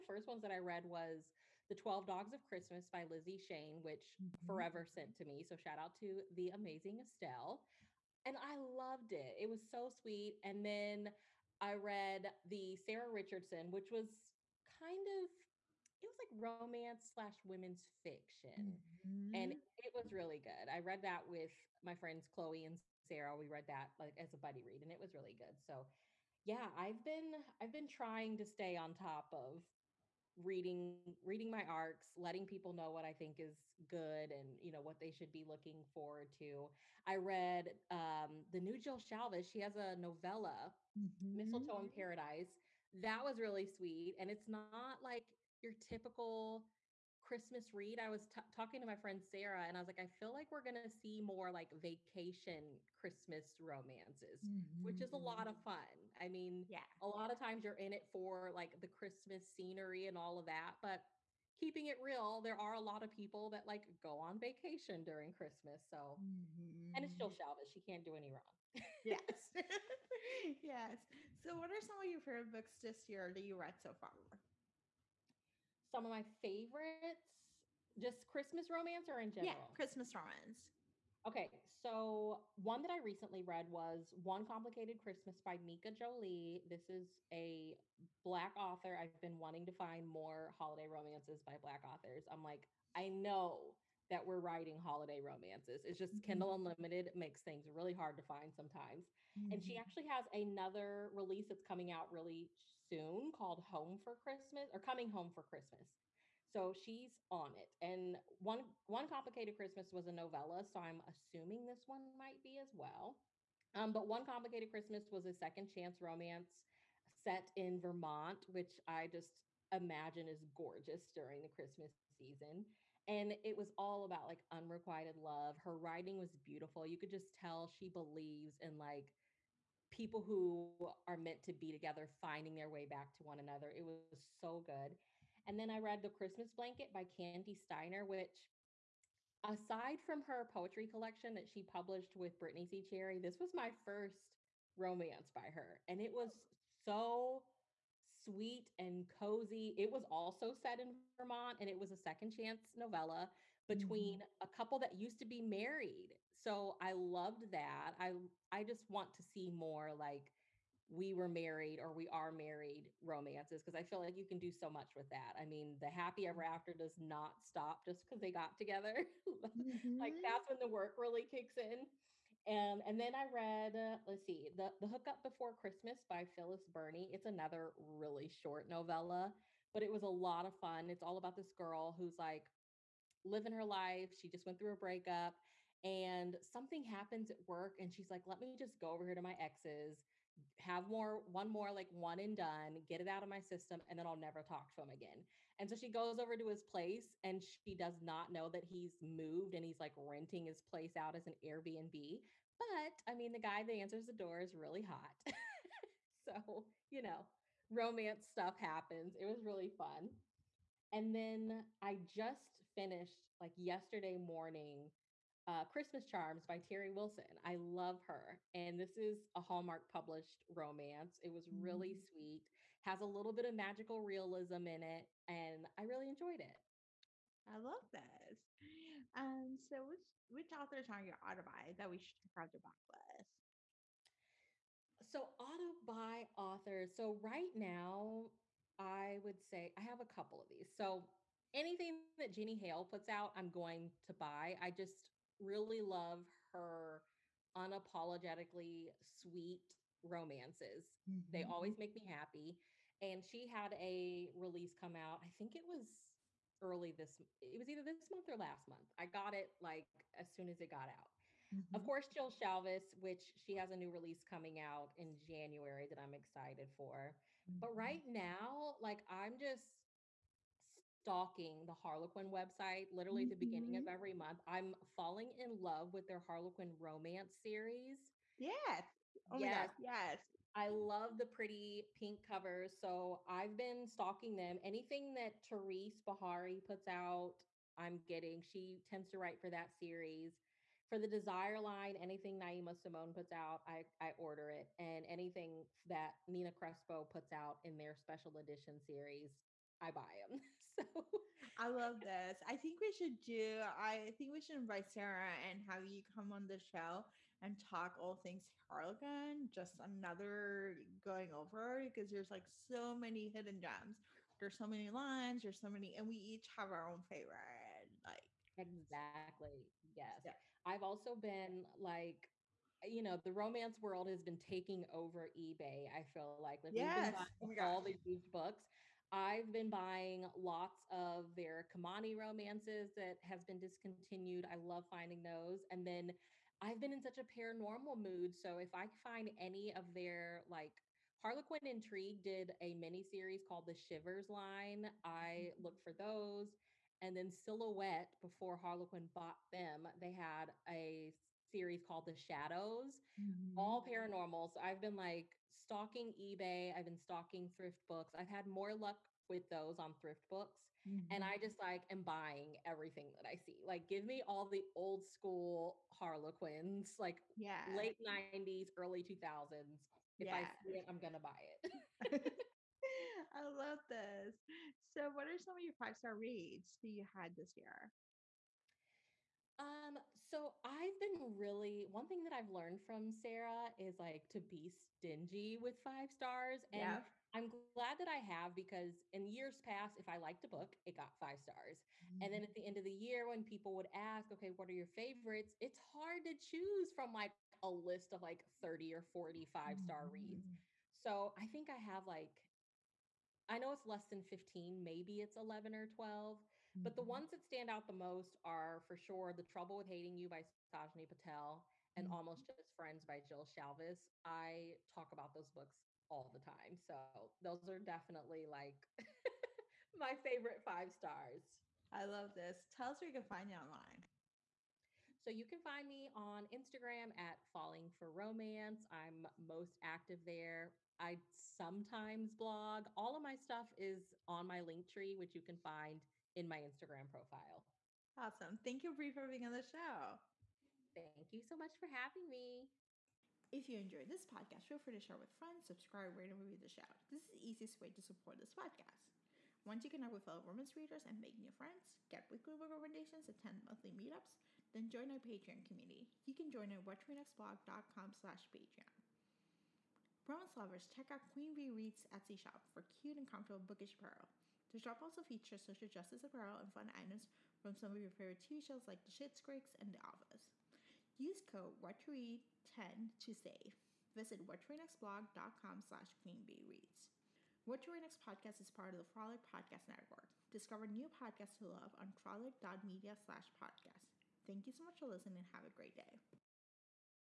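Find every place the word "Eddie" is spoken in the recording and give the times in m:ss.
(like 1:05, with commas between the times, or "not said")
not said.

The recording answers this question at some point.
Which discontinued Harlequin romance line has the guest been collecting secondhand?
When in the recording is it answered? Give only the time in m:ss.
5:31.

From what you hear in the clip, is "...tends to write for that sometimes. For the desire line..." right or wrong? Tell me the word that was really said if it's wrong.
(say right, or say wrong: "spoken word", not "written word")
wrong: "series", not "sometimes".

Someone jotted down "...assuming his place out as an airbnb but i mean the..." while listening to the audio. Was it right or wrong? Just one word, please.
wrong.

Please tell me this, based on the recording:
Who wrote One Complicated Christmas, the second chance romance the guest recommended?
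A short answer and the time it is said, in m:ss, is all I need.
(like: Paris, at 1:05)
Mika Jolie, at 1:25.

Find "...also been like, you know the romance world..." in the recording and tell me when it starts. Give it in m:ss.
5:20.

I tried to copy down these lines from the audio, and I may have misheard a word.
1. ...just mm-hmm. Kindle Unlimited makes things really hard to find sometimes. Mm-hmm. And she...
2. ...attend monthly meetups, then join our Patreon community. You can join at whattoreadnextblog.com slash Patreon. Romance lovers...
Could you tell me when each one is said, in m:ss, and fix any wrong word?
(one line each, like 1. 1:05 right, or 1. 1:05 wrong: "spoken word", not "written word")
1. 1:35 right
2. 7:33 right.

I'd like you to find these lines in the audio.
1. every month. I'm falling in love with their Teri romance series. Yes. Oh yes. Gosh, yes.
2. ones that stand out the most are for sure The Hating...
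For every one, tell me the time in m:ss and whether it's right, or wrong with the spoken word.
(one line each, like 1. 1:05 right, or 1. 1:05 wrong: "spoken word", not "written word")
1. 4:33 wrong: "Harlequin", not "Teri"
2. 6:47 wrong: "Trouble", not "Hating".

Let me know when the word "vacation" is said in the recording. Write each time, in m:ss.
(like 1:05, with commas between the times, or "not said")
0:51, 1:04.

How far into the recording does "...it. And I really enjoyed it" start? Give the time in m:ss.
3:44.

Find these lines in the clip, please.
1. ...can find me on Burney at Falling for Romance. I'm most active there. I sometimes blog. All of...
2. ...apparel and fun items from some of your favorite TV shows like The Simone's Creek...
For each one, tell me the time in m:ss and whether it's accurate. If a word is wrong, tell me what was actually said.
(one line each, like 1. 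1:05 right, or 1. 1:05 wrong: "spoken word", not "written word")
1. 7:05 wrong: "Instagram", not "Burney"
2. 7:46 wrong: "Schitt", not "Simone".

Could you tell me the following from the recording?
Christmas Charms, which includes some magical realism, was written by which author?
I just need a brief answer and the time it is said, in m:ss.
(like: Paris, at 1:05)
Teri Wilson, at 3:36.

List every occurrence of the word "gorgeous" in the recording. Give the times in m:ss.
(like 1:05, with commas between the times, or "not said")
2:00.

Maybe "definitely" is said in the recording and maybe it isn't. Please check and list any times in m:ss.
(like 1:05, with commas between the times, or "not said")
6:57.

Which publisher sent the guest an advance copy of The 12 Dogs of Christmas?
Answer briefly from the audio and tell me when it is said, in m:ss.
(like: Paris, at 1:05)
Forever, at 0:04.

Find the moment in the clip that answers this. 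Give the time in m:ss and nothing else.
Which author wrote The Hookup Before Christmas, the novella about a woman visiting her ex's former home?
2:56.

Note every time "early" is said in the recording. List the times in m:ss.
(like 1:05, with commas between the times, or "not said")
4:16, 6:08.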